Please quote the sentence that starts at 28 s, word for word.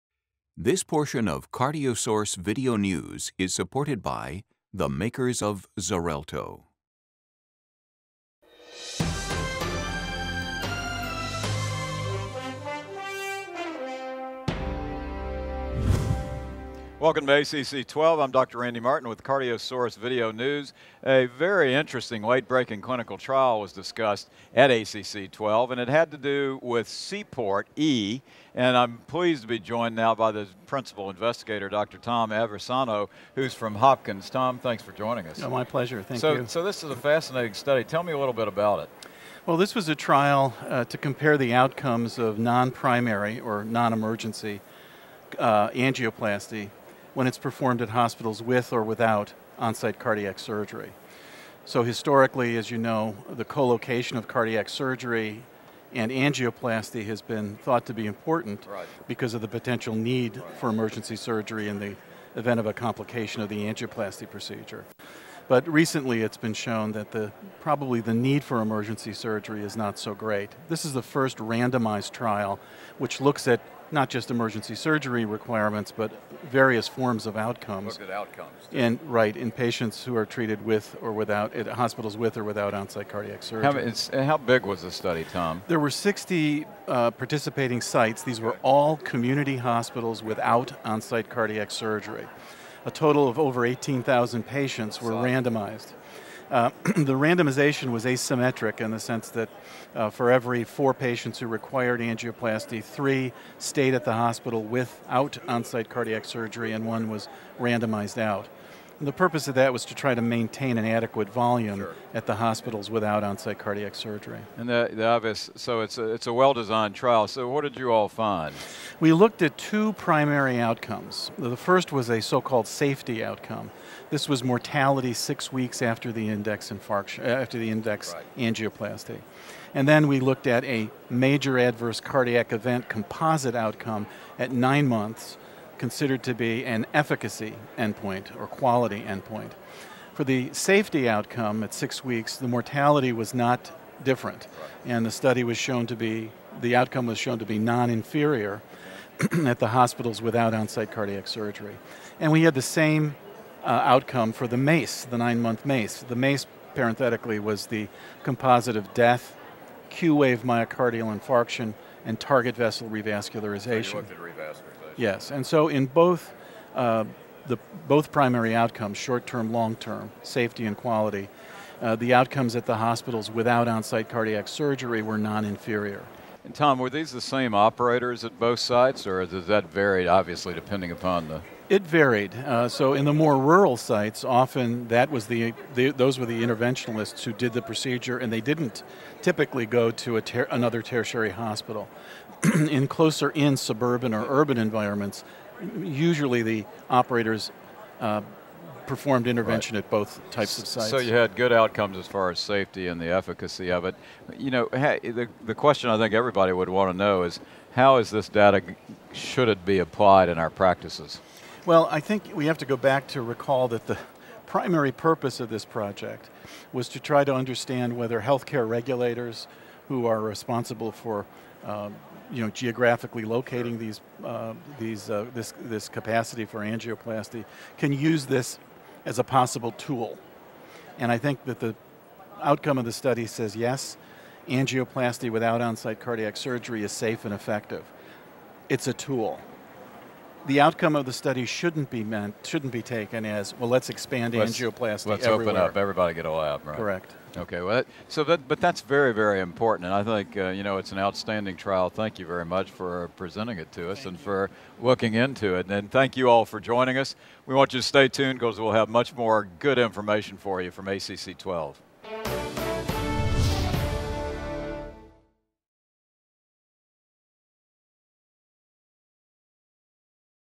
And I'm pleased to be joined now by the principal investigator, Dr.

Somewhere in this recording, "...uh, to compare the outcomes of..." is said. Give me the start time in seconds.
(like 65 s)
40 s.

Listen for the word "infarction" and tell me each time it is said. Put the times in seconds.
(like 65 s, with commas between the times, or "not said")
126 s, 161 s.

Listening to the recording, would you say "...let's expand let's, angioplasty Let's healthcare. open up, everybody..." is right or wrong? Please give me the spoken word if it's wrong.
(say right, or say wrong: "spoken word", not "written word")
wrong: "everywhere", not "healthcare".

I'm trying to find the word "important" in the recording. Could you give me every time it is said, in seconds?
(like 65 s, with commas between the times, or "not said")
58 s, 249 s.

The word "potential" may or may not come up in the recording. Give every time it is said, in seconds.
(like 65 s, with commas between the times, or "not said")
59 s.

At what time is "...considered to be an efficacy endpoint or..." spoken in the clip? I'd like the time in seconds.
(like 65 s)
135 s.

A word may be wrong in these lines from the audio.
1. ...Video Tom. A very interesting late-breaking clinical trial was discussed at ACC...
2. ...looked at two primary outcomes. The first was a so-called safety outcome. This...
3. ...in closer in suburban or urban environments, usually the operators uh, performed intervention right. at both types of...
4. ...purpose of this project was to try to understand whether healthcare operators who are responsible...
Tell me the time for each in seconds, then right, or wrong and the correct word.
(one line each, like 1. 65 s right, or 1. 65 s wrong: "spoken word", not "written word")
1. 19 s wrong: "News", not "Tom"
2. 119 s right
3. 192 s right
4. 214 s wrong: "regulators", not "operators".